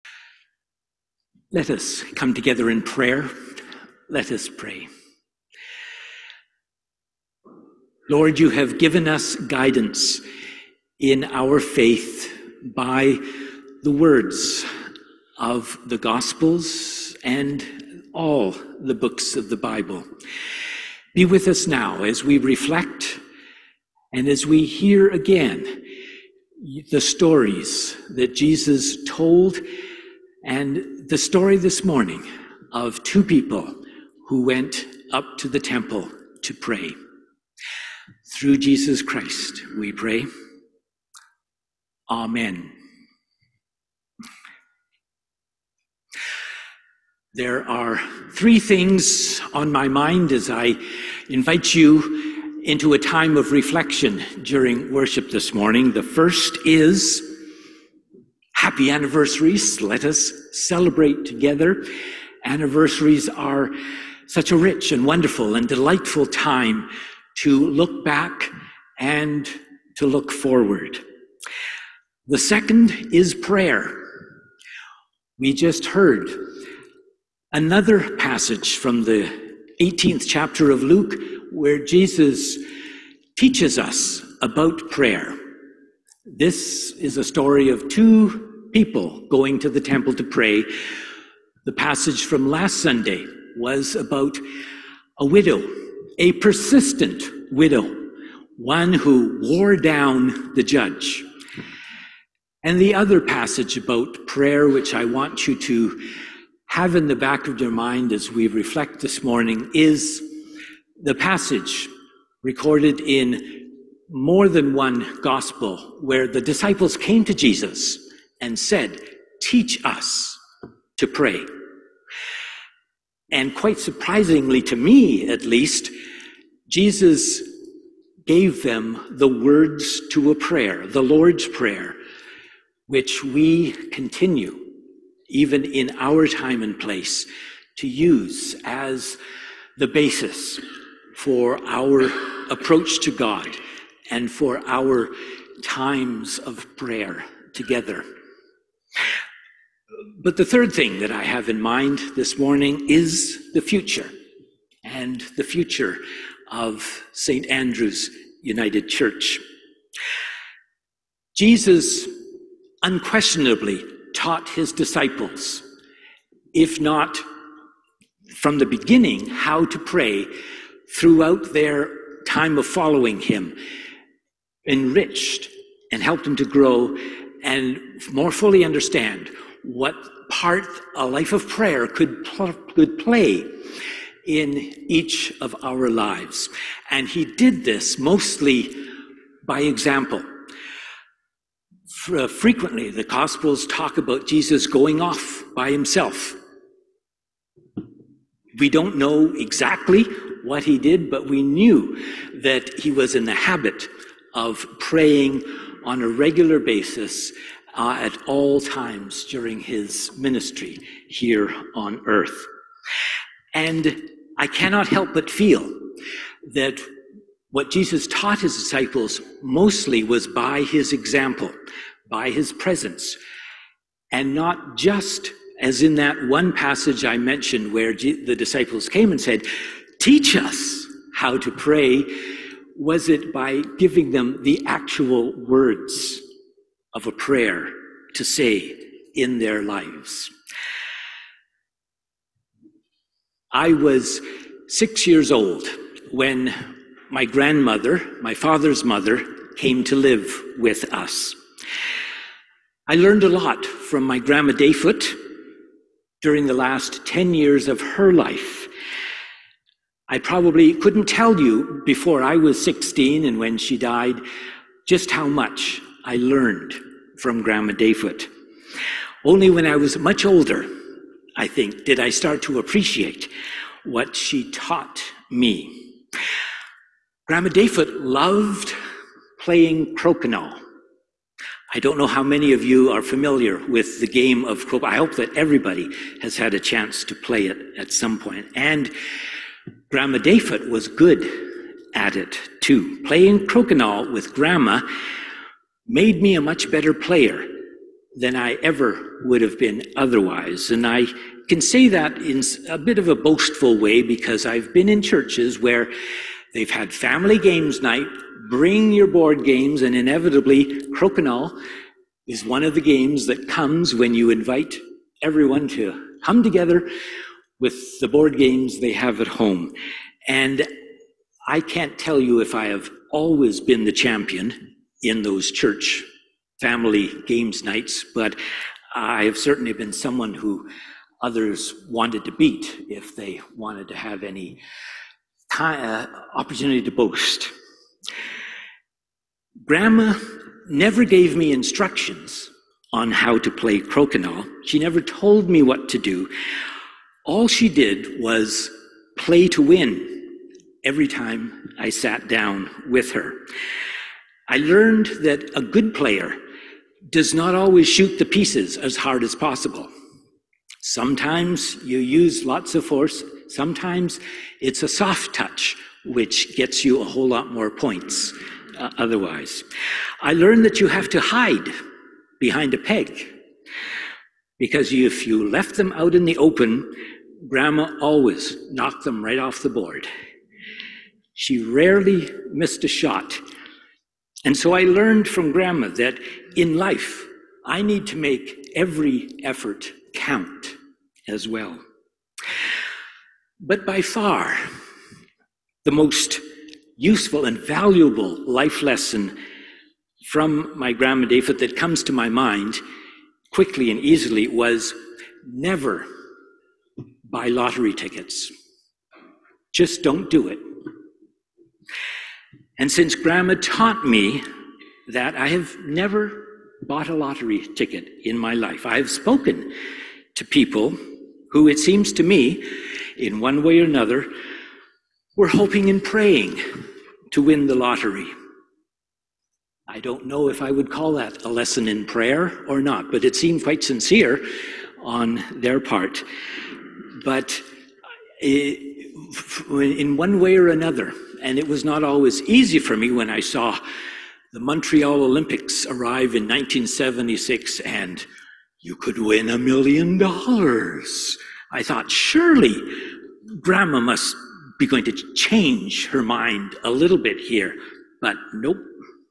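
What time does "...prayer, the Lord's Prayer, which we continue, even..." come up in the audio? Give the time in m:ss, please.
2:10.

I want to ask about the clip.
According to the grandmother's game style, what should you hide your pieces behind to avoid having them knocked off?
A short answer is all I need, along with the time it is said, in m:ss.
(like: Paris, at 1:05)
A peg, at 6:12.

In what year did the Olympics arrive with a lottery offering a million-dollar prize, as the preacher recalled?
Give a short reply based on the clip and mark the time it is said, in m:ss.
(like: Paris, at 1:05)
1976, at 7:26.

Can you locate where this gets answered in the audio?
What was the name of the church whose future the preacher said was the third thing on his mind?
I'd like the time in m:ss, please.
2:37.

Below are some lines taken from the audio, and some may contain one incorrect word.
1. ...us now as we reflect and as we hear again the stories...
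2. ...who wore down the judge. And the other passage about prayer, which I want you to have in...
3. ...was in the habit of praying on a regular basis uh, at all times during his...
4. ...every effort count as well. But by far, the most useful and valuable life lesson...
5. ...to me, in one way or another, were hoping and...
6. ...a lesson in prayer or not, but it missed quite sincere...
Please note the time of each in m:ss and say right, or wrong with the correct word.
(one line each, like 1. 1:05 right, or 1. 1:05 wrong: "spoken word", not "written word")
1. 0:21 right
2. 1:38 right
3. 3:22 right
4. 6:28 right
5. 7:02 right
6. 7:11 wrong: "seemed", not "missed".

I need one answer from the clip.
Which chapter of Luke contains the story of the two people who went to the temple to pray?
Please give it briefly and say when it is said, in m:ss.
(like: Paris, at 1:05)
18th, at 1:19.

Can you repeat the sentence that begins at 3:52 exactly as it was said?
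Was it by giving them the actual words?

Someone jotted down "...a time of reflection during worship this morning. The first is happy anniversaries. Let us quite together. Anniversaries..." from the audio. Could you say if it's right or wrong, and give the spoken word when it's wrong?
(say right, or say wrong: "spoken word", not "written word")
wrong: "celebrate", not "quite".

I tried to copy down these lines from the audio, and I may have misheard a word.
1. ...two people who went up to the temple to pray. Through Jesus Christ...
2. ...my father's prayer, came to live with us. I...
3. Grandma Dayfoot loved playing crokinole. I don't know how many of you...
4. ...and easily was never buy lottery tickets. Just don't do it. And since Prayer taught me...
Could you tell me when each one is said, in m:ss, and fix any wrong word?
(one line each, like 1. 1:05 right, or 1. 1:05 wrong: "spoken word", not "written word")
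1. 0:33 right
2. 4:08 wrong: "mother", not "prayer"
3. 4:37 right
4. 6:43 wrong: "Grandma", not "Prayer".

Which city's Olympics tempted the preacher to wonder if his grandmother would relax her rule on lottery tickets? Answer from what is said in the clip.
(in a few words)
Montreal.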